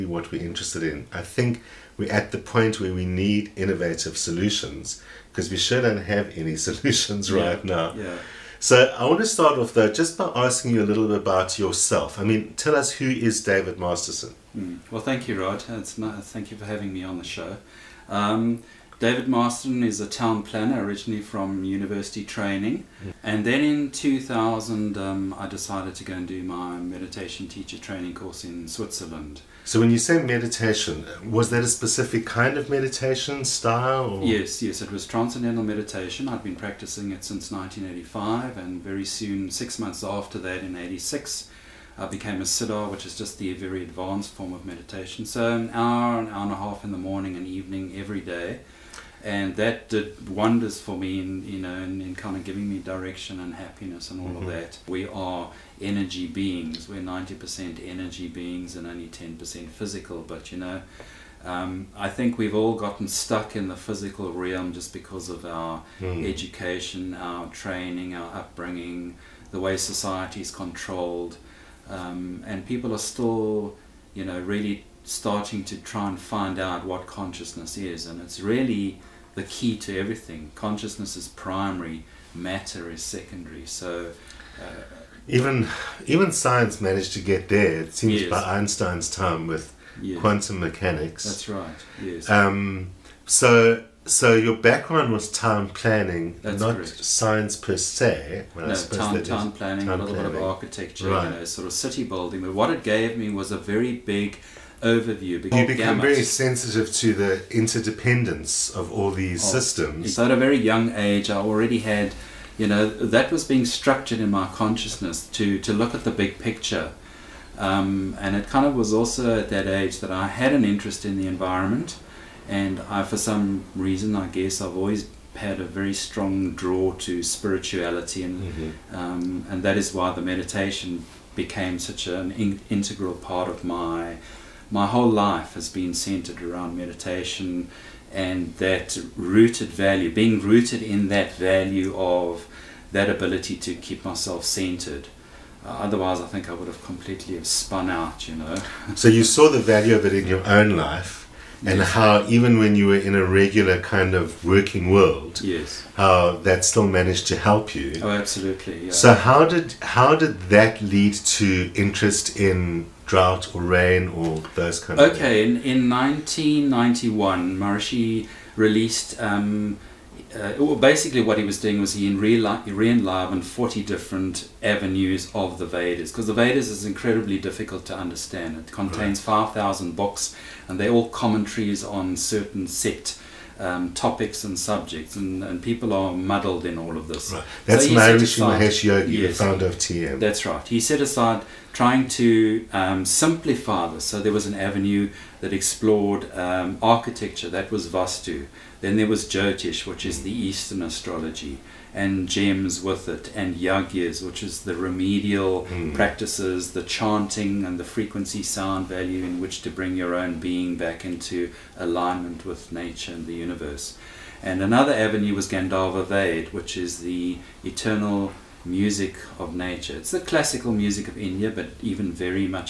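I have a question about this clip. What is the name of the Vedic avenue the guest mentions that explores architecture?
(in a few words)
Vastu.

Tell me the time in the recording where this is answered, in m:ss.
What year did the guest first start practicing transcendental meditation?
0:37.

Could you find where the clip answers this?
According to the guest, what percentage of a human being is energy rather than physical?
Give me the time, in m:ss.
0:57.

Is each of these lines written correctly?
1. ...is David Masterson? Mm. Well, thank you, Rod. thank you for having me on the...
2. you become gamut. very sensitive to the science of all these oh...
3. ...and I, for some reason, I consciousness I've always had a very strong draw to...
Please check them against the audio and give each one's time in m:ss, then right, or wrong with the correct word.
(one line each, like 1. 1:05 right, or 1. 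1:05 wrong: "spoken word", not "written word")
1. 0:13 right
2. 1:45 wrong: "interdependence", not "science"
3. 2:02 wrong: "guess", not "consciousness".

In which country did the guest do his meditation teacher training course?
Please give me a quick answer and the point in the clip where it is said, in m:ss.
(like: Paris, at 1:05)
Switzerland, at 0:28.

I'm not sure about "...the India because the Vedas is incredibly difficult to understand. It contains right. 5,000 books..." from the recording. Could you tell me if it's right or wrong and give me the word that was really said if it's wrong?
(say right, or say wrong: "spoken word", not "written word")
wrong: "Vedas", not "India".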